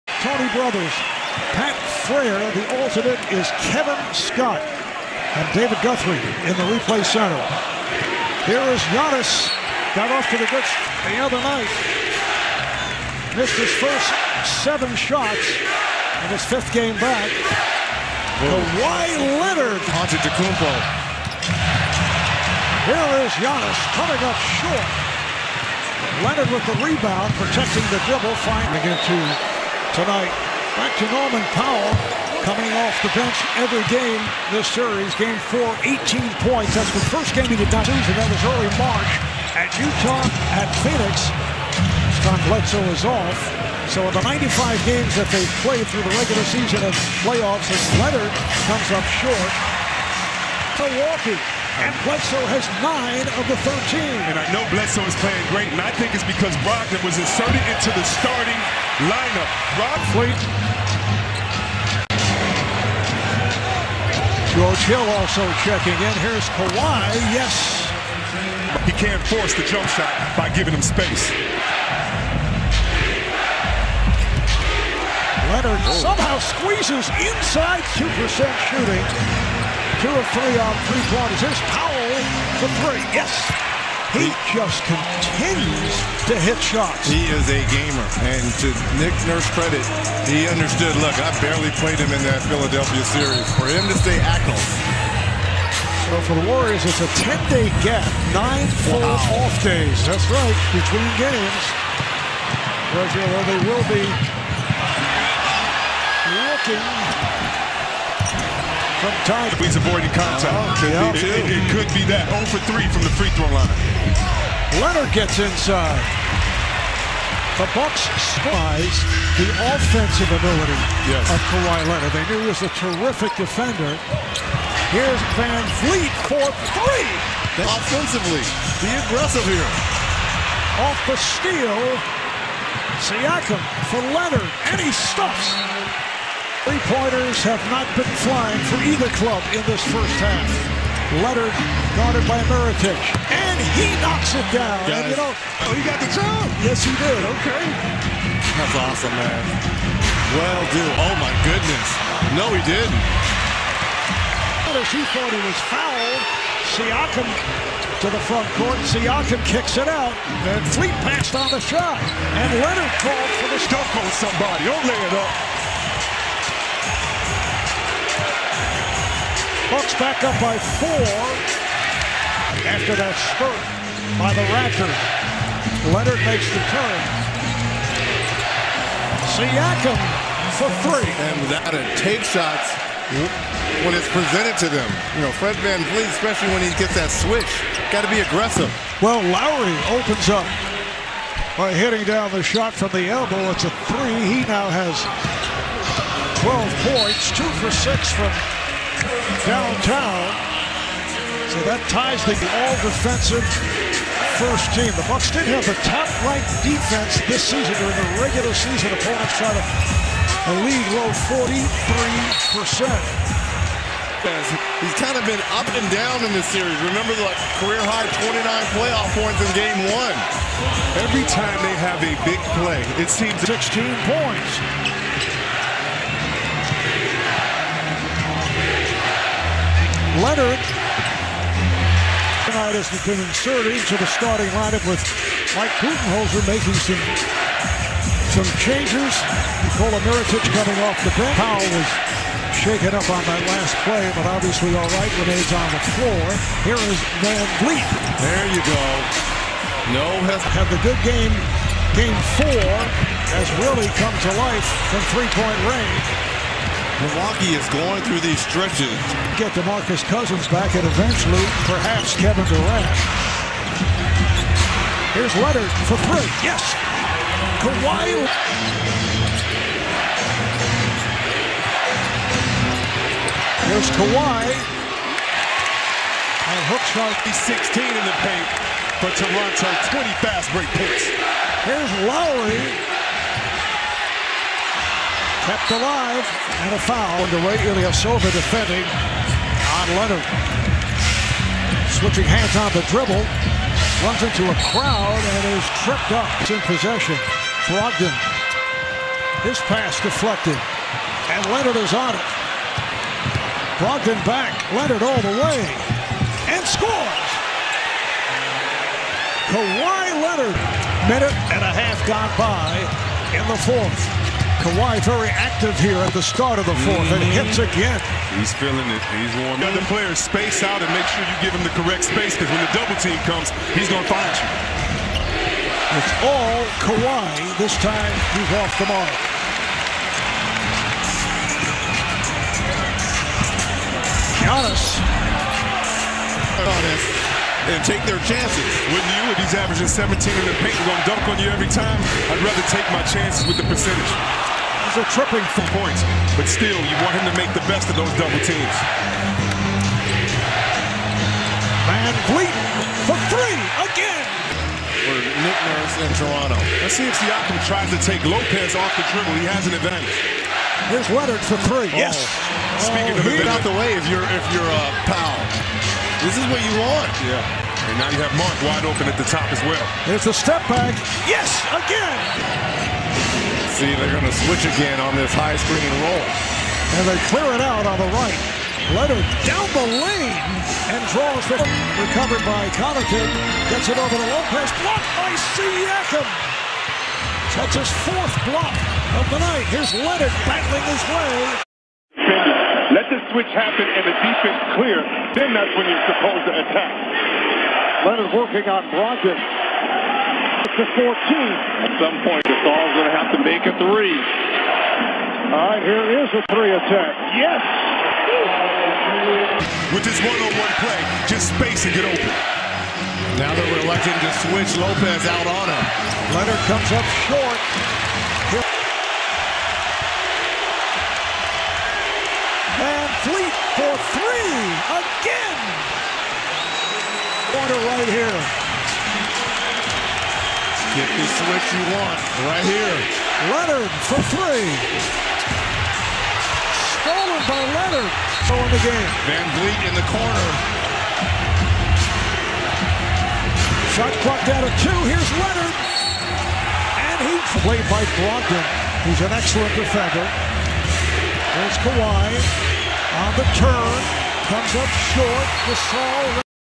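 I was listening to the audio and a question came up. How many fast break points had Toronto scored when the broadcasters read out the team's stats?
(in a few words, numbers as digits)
20.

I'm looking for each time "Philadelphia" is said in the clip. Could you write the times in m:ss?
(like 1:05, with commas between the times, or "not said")
1:32.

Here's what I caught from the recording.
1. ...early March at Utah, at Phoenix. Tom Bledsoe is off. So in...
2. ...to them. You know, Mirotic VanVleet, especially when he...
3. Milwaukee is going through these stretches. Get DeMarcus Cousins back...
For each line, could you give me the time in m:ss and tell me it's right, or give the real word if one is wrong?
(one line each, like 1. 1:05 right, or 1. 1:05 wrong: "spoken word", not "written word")
1. 0:38 right
2. 3:04 wrong: "Fred", not "Mirotic"
3. 4:17 right.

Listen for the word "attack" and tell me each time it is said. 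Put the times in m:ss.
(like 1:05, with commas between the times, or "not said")
6:36, 6:46.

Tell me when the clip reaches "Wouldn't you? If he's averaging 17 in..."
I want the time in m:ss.
5:38.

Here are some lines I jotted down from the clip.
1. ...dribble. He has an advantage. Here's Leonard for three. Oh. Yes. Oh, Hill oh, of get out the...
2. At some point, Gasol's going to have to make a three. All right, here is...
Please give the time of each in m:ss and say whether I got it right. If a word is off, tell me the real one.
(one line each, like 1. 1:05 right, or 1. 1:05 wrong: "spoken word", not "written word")
1. 5:59 wrong: "Speaking", not "Hill"
2. 6:41 right.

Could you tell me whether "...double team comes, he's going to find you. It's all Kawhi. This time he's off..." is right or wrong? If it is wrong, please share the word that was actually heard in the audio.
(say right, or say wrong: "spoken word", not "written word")
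right.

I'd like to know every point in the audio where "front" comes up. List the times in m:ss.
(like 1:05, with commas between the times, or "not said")
2:38.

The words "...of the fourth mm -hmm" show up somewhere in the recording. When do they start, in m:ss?
5:16.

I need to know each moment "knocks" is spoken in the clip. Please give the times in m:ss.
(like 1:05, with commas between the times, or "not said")
2:24.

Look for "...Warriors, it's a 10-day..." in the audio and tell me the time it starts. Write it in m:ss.
1:36.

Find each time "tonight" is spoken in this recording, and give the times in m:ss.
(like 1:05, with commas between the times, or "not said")
0:29, 3:52.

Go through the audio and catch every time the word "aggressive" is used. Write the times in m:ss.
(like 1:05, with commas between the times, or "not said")
2:09, 3:08.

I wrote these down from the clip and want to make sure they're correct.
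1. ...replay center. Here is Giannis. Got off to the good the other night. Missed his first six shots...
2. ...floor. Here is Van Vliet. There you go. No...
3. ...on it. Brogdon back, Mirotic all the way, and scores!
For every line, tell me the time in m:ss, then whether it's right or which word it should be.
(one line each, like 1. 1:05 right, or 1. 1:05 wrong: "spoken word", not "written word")
1. 0:06 wrong: "seven", not "six"
2. 4:05 right
3. 5:01 wrong: "Leonard", not "Mirotic".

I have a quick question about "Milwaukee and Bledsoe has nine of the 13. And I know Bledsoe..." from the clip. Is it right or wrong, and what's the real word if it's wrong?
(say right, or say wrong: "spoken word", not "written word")
right.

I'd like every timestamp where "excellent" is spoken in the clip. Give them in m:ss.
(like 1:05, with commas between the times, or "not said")
7:29.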